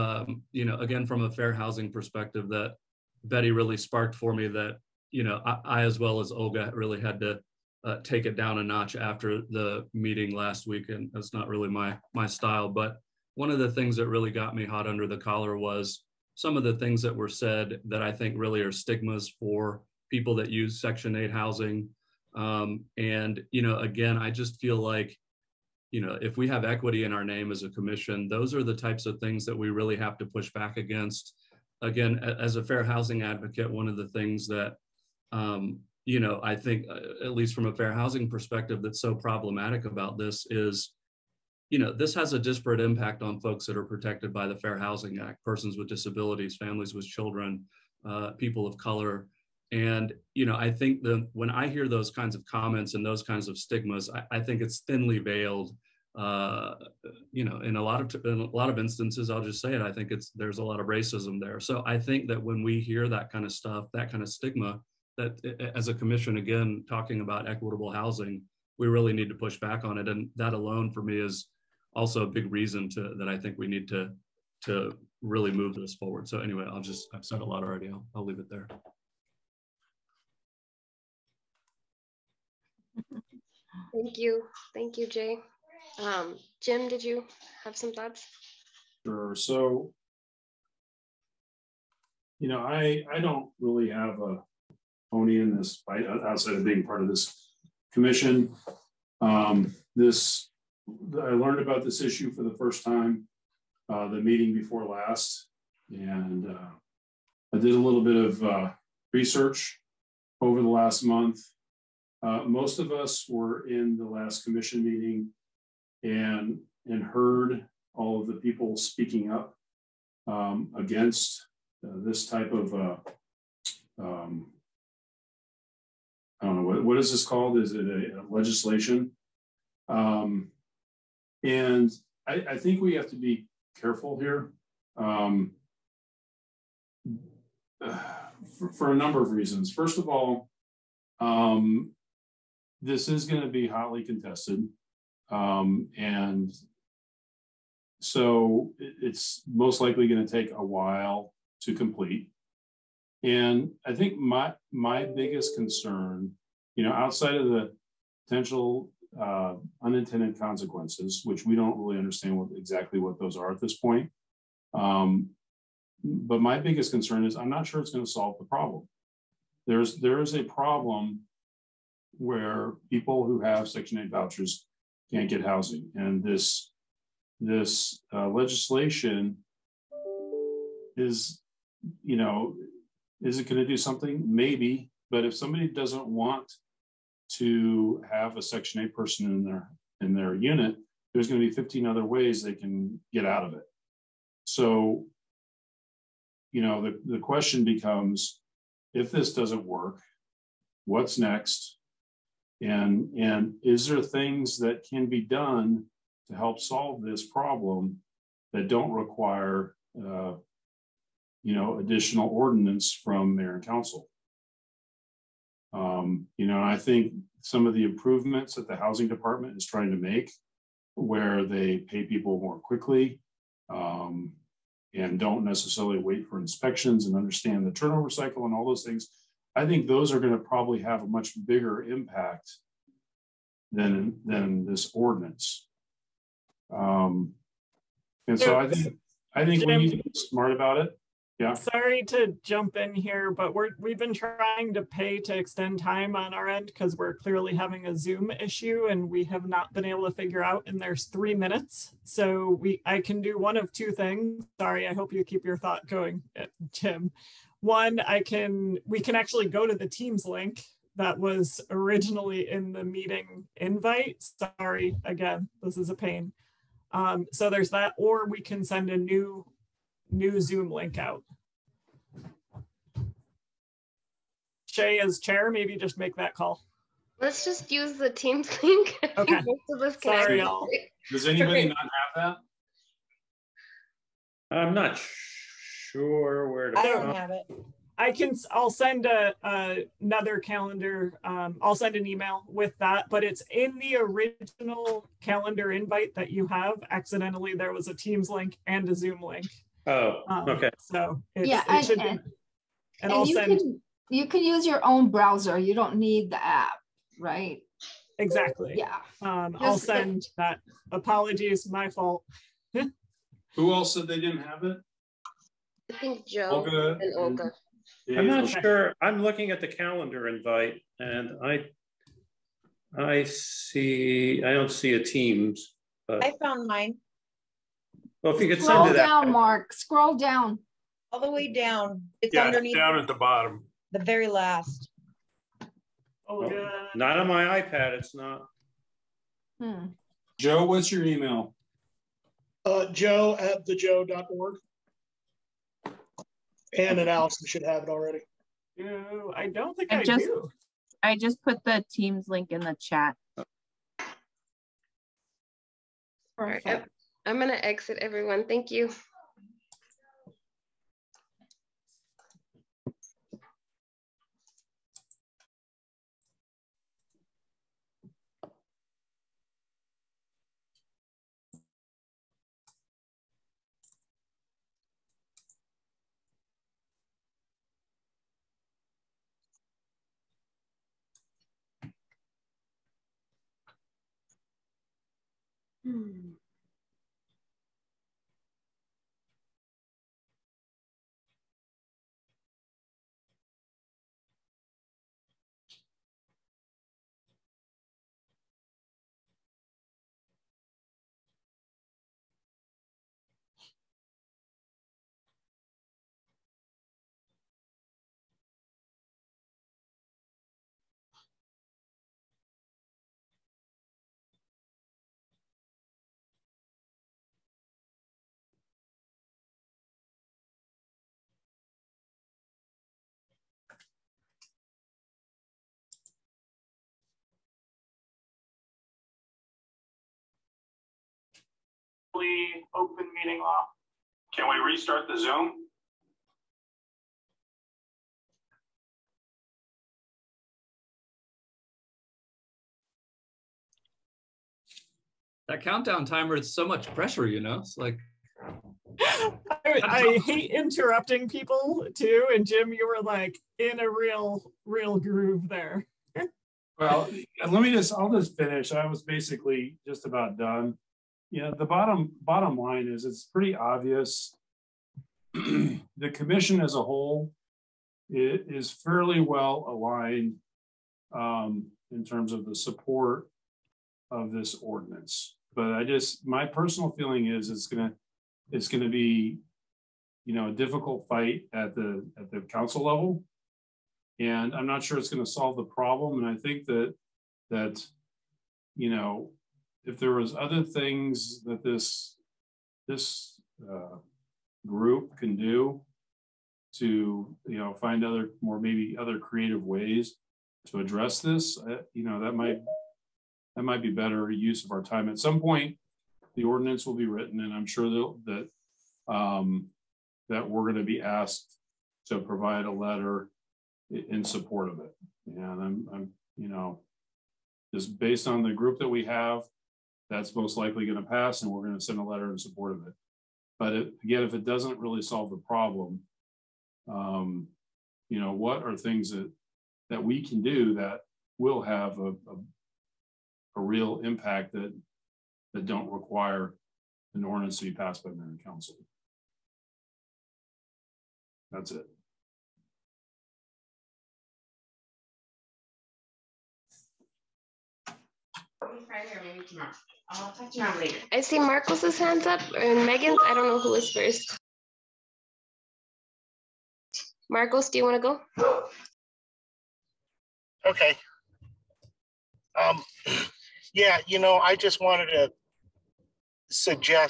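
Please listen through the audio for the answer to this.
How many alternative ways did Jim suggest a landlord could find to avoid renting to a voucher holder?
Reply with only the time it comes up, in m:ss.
3:11.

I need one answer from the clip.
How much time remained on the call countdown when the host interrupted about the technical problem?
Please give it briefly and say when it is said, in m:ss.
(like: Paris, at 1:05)
three minutes, at 4:11.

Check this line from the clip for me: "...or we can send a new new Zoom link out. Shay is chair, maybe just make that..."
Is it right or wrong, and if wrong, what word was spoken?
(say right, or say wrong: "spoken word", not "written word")
right.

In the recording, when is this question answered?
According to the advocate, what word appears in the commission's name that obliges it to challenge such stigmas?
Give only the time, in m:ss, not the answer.
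0:26.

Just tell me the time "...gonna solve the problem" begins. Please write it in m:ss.
8:05.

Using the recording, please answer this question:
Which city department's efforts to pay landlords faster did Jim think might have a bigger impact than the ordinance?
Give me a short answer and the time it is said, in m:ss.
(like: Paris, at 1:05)
housing department, at 3:38.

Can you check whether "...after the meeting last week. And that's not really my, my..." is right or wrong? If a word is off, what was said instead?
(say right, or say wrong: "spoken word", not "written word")
right.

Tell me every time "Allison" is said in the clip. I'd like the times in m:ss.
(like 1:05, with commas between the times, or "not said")
5:47.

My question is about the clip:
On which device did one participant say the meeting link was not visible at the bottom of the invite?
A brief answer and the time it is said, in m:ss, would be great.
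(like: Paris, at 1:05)
iPad, at 5:37.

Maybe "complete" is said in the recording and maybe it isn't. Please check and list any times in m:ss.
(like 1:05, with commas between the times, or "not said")
2:31.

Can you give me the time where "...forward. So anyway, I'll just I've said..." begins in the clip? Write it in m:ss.
1:15.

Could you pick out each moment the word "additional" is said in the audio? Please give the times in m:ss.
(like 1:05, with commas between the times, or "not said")
3:31.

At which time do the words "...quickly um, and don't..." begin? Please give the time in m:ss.
3:42.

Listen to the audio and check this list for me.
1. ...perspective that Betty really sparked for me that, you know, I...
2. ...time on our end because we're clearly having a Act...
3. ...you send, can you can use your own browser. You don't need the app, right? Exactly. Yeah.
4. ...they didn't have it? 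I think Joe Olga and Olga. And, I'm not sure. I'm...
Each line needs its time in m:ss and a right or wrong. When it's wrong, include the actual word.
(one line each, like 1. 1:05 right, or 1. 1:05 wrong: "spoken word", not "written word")
1. 0:01 right
2. 4:05 wrong: "Zoom", not "Act"
3. 5:03 right
4. 5:14 right.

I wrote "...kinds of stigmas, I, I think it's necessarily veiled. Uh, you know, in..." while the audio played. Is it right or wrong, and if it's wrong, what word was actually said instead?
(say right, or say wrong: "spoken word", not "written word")
wrong: "thinly", not "necessarily".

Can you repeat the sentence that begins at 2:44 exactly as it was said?
Um, but my biggest concern is I'm not sure it's going to solve the problem.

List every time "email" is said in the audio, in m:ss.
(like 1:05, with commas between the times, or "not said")
4:52, 5:41.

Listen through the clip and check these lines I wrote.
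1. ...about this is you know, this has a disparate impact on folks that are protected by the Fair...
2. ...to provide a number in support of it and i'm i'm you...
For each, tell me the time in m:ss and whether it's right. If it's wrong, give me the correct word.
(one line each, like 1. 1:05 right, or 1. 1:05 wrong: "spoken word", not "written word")
1. 0:39 right
2. 8:32 wrong: "letter", not "number".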